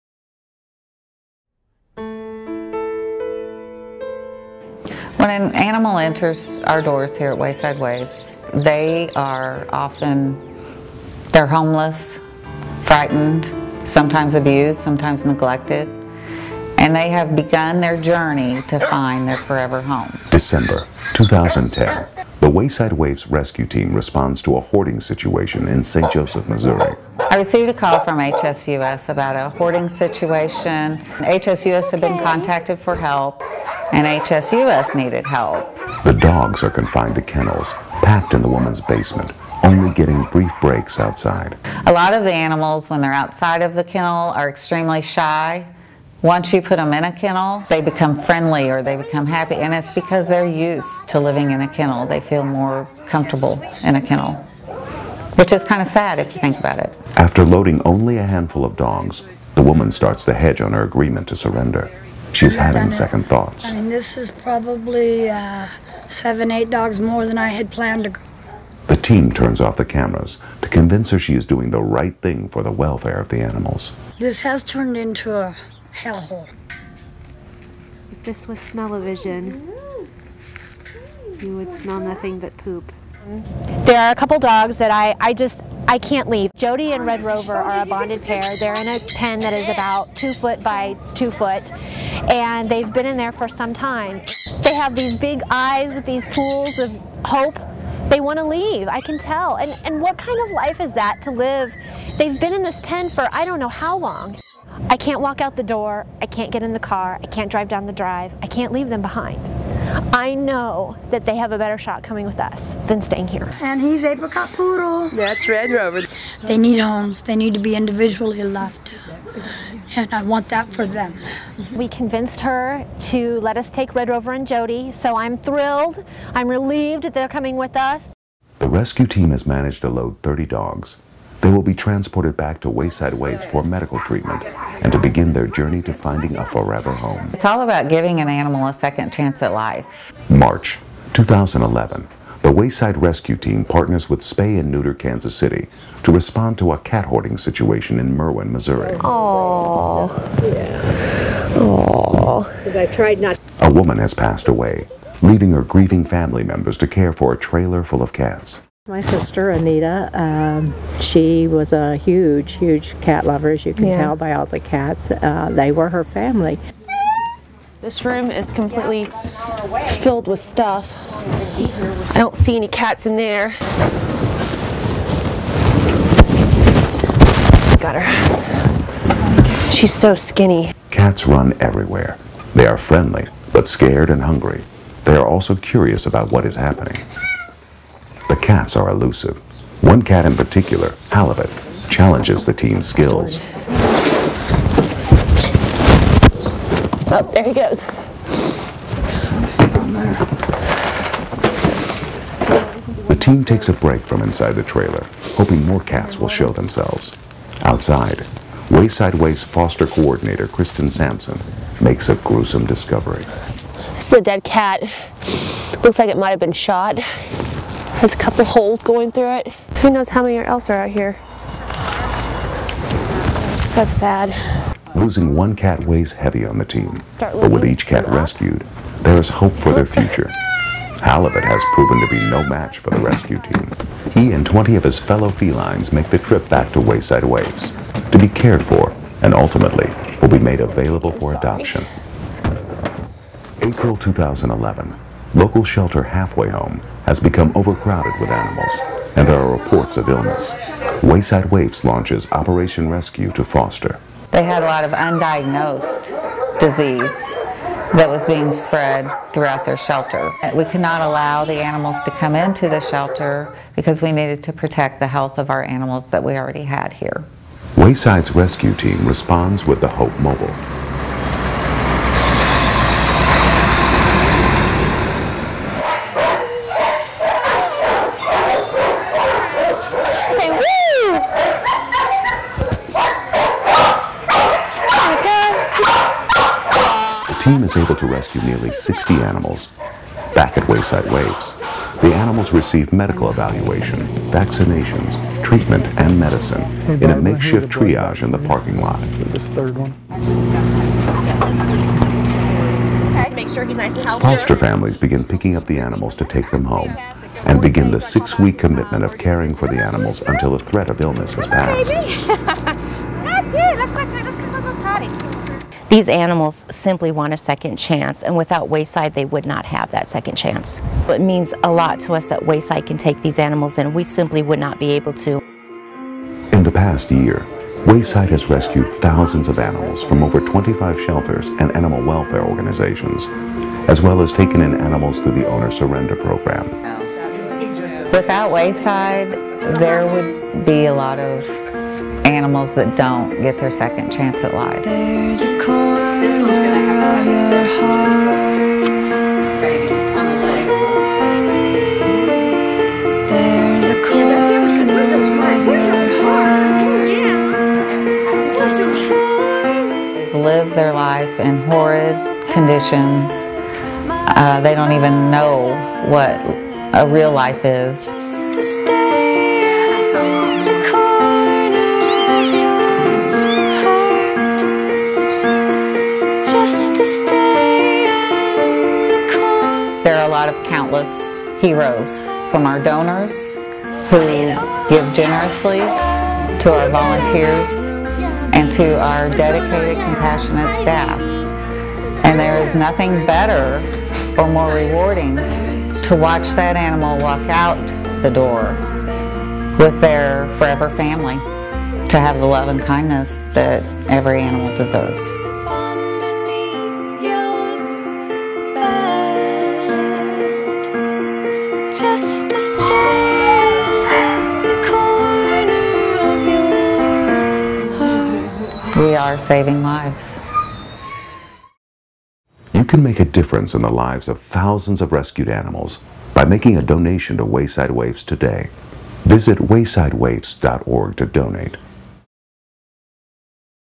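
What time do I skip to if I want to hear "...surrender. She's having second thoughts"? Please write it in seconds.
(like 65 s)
61 s.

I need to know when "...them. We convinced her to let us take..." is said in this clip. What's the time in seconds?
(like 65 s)
120 s.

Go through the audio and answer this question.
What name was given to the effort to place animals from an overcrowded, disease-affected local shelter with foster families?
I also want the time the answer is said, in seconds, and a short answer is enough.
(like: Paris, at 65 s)
Operation Rescue to foster, at 252 s.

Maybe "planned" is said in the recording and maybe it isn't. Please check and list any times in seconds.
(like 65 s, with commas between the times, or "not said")
67 s.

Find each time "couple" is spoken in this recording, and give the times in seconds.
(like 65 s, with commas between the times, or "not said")
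84 s, 218 s.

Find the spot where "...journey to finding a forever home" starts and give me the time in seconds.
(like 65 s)
135 s.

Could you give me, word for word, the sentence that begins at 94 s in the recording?
They have these big eyes with these pools of hope.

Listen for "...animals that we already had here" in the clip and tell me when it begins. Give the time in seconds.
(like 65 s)
265 s.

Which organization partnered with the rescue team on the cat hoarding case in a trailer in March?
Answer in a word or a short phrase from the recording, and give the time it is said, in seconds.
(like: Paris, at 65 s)
Spay and Neuter Kansas City, at 144 s.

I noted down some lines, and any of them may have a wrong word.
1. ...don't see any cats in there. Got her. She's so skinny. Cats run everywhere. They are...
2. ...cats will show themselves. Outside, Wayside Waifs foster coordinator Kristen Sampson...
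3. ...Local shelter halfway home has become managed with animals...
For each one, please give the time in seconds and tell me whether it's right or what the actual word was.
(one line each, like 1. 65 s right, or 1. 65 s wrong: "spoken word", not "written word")
1. 172 s right
2. 205 s right
3. 245 s wrong: "overcrowded", not "managed".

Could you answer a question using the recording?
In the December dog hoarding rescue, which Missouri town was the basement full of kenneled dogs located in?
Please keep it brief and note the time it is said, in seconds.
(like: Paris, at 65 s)
St. Joseph, at 25 s.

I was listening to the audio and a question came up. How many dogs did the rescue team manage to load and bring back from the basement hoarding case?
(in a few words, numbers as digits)
30.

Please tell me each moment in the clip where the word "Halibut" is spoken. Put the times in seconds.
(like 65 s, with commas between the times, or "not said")
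191 s, 231 s.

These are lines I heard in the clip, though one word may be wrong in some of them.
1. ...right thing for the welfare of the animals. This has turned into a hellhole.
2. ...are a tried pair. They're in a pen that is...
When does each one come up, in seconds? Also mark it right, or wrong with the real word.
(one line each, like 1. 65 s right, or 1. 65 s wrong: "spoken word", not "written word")
1. 71 s right
2. 87 s wrong: "bonded", not "tried".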